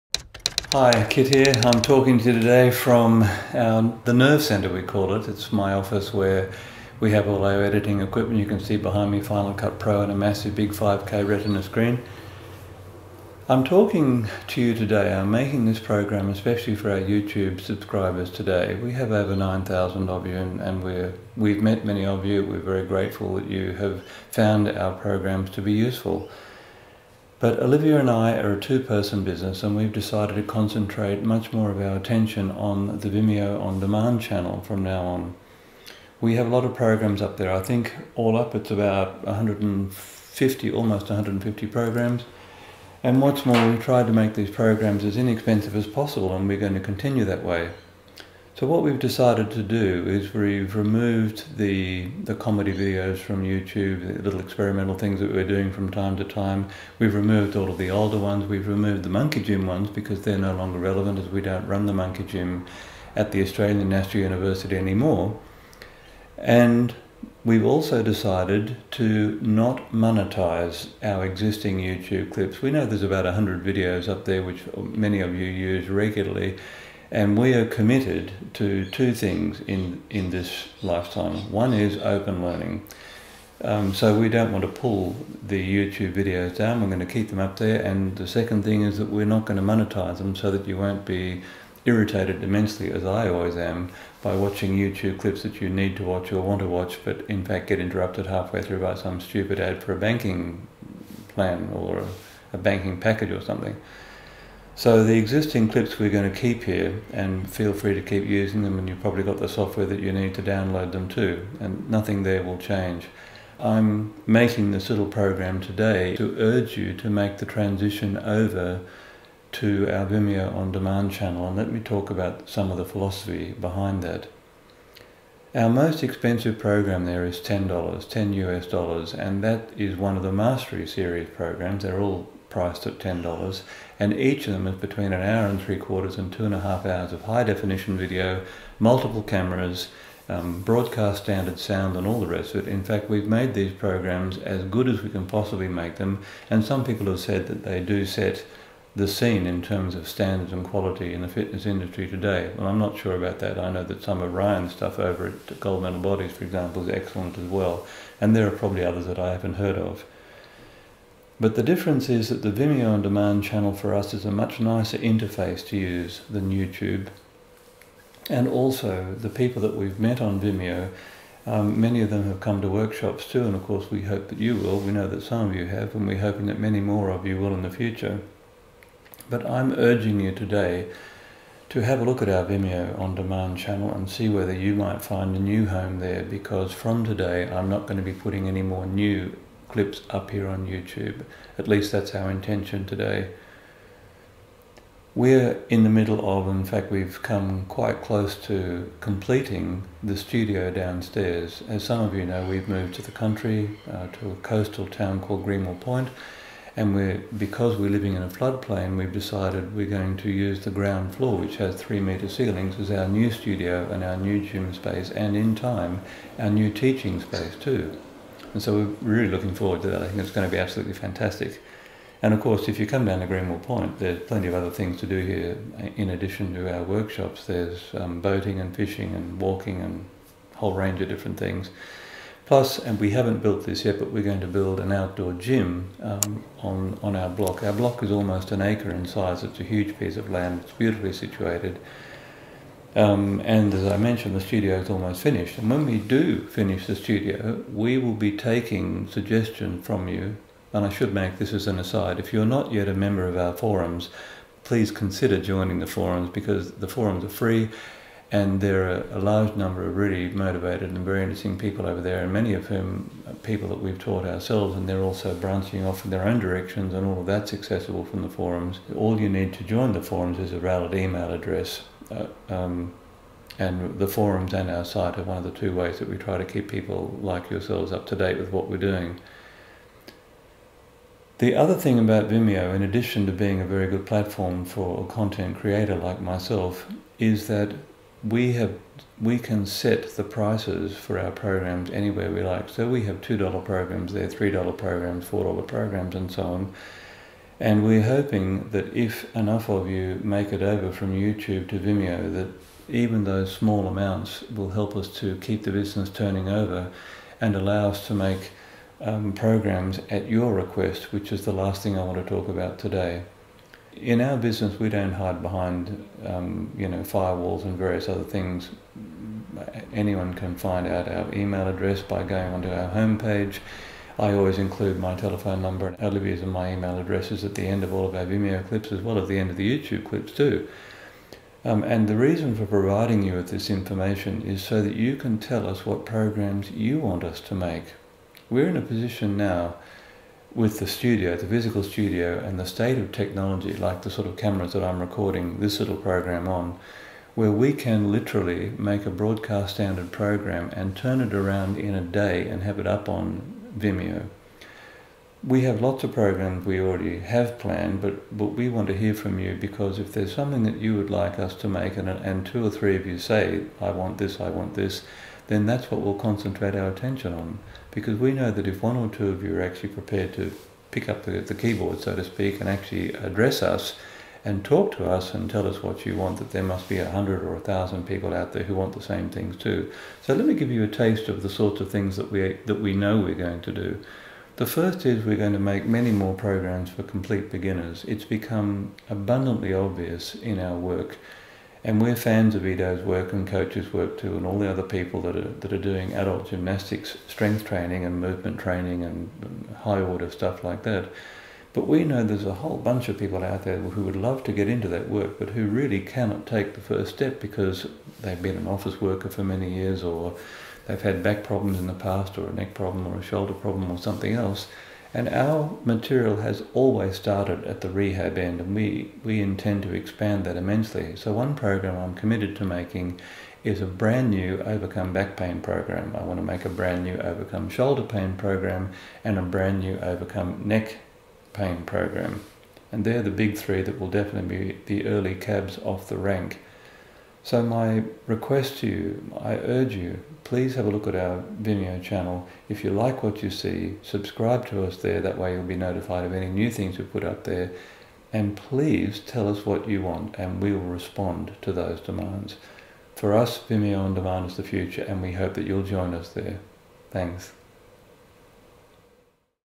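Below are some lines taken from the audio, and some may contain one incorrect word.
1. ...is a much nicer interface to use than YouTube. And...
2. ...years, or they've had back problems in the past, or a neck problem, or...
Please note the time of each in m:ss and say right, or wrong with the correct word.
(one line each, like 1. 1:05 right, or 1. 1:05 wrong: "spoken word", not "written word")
1. 2:44 right
2. 6:49 right.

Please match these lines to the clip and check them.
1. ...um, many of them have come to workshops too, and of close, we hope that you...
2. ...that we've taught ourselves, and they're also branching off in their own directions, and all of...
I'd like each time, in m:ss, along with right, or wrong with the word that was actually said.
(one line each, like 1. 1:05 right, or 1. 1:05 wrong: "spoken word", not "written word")
1. 2:51 wrong: "course", not "close"
2. 4:23 right.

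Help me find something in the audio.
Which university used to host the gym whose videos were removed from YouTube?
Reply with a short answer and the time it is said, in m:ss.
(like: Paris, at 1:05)
Australian National University, at 1:03.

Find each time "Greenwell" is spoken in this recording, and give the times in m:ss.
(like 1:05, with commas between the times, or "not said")
3:25, 3:43.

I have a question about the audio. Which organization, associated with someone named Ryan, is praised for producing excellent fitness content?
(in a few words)
Gold Medal Bodies.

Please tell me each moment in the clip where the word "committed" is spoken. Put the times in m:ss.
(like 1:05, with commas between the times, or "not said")
1:17, 7:02.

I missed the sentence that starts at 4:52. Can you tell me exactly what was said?
So we have two dollar programs there, three dollar programs, four dollar programs, and so on.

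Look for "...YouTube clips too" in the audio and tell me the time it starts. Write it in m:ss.
5:29.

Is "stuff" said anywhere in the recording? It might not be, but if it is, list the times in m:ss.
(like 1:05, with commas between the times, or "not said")
2:34, 6:40.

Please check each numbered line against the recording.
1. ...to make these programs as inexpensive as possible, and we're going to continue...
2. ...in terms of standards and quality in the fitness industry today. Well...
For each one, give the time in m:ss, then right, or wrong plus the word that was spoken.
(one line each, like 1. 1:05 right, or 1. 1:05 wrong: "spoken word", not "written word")
1. 0:44 right
2. 2:29 right.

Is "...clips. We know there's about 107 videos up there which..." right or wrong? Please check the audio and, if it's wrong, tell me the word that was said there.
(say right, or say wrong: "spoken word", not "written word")
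wrong: "100", not "107".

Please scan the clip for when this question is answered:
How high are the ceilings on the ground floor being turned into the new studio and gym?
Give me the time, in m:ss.
3:31.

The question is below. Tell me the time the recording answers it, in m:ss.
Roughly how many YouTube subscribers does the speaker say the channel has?
0:19.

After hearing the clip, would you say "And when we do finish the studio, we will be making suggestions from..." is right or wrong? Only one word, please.
wrong.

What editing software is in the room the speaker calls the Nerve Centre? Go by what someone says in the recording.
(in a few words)
Final Cut Pro.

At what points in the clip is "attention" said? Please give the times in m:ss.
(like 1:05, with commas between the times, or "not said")
0:31, 6:06.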